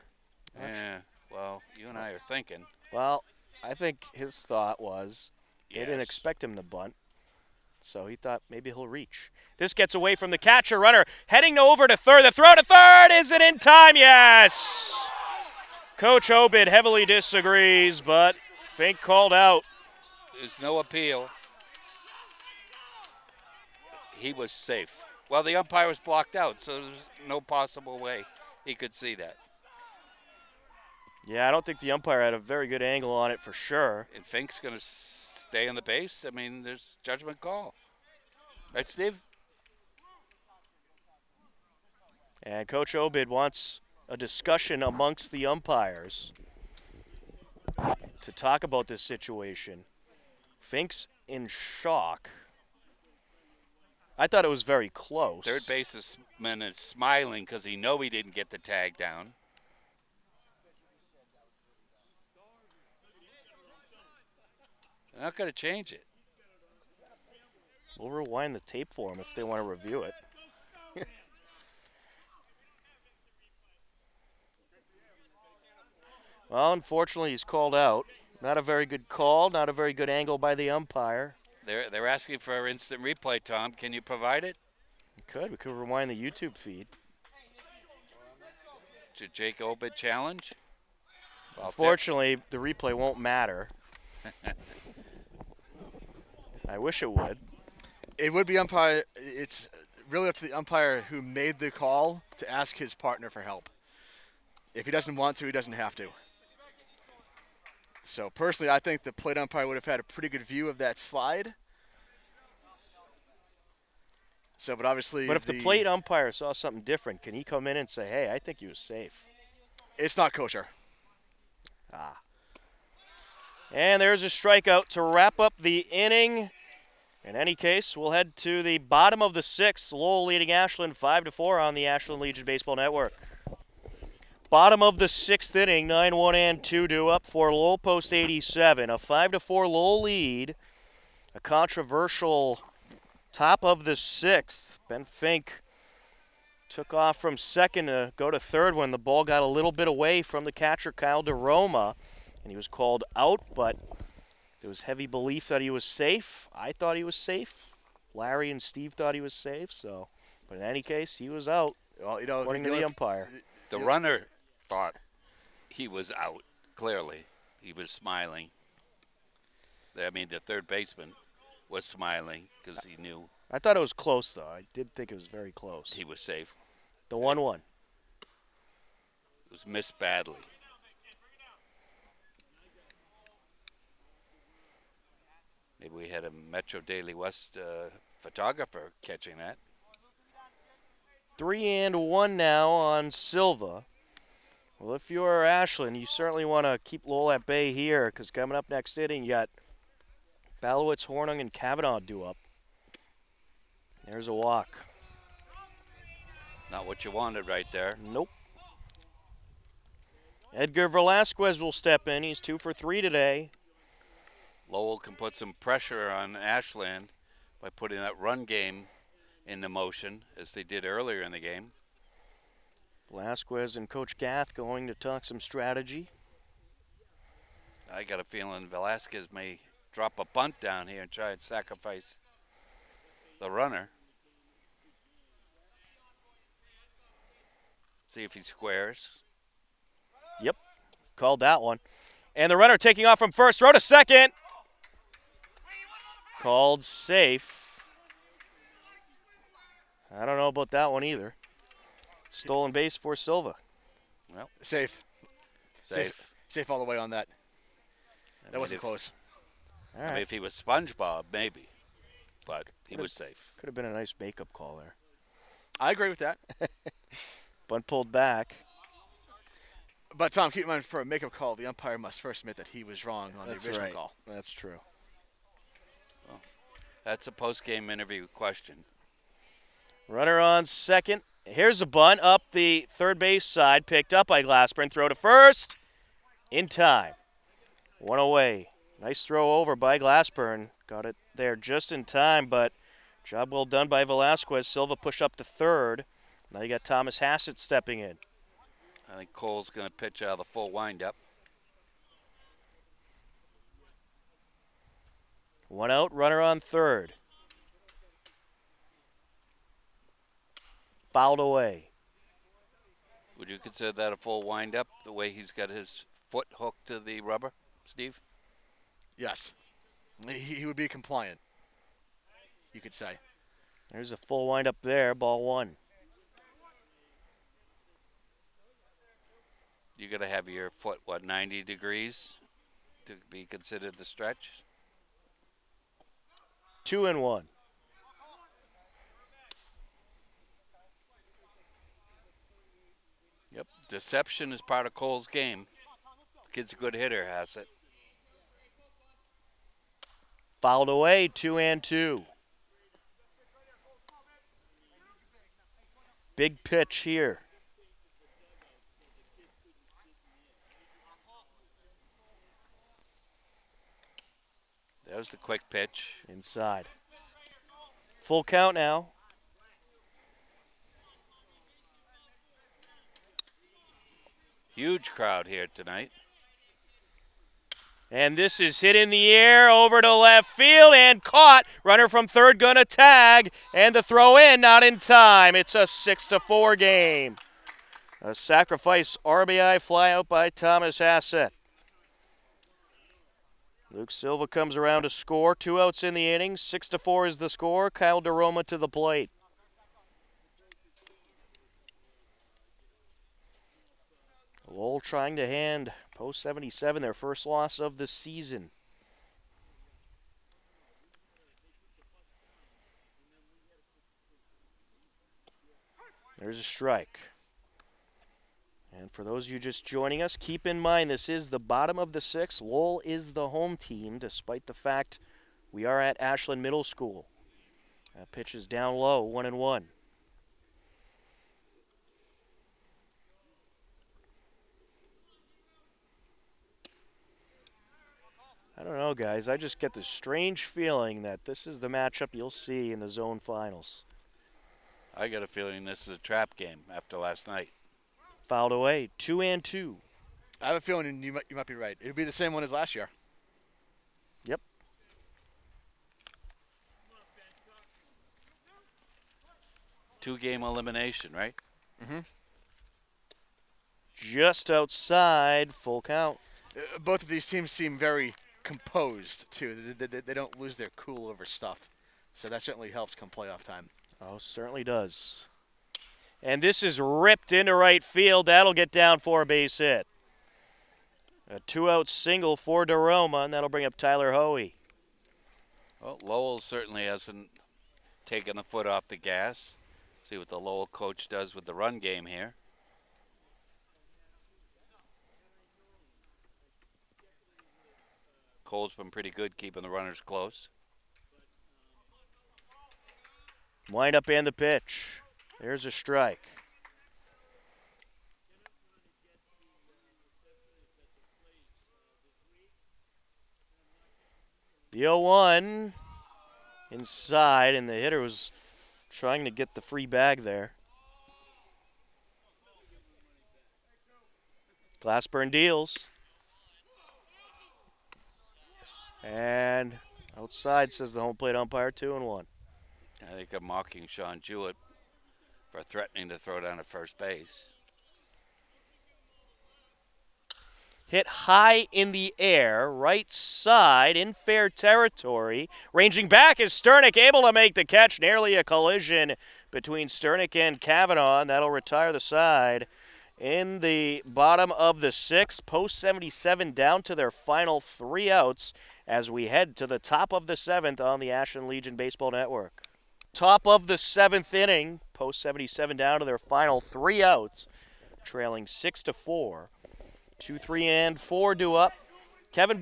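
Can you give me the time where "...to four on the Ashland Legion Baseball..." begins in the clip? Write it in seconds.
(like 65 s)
131 s.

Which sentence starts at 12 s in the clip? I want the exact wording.
The throw to third, is it in time?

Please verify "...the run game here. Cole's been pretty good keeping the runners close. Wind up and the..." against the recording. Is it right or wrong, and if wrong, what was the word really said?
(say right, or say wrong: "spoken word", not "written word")
right.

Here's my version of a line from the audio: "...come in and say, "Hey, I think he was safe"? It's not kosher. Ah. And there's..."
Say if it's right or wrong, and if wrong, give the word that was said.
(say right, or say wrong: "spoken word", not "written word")
right.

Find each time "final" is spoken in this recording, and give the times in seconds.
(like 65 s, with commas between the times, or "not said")
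443 s, 557 s, 566 s.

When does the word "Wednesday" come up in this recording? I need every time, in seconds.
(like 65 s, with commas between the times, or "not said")
not said.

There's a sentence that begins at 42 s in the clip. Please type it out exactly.
And Coach Obid wants a discussion amongst the umpires to talk about this situation.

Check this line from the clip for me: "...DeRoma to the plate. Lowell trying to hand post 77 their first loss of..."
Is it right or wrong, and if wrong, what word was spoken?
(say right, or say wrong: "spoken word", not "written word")
right.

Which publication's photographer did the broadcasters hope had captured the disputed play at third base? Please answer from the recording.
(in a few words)
Metro Daily West.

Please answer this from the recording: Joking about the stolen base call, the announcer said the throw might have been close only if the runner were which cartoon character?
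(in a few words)
SpongeBob.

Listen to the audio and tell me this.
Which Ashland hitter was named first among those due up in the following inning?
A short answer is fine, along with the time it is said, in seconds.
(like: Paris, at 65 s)
Balowitz, at 200 s.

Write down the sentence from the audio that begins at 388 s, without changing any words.
A sacrifice RBI flyout by Thomas Hassett.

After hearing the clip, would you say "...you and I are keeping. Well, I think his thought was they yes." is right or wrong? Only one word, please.
wrong.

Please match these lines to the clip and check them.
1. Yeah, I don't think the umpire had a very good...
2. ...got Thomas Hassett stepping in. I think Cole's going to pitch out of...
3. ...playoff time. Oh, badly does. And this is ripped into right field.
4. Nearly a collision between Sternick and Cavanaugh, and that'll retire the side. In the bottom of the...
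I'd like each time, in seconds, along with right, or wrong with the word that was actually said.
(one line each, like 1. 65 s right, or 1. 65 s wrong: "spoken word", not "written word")
1. 31 s right
2. 296 s right
3. 473 s wrong: "certainly", not "badly"
4. 548 s right.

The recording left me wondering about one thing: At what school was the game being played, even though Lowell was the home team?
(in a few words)
Ashland Middle School.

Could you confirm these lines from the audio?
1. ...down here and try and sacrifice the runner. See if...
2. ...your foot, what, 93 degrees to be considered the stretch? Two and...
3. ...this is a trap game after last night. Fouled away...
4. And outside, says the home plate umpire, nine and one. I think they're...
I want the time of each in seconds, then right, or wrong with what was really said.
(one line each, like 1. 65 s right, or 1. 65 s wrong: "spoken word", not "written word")
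1. 230 s right
2. 330 s wrong: "90", not "93"
3. 445 s right
4. 529 s wrong: "two", not "nine".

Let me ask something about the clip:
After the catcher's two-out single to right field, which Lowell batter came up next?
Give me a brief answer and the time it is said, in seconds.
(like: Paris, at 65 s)
Tyler Hoey, at 483 s.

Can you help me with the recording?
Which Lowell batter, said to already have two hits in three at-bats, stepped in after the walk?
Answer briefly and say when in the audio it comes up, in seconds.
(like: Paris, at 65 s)
Edgar Velasquez, at 210 s.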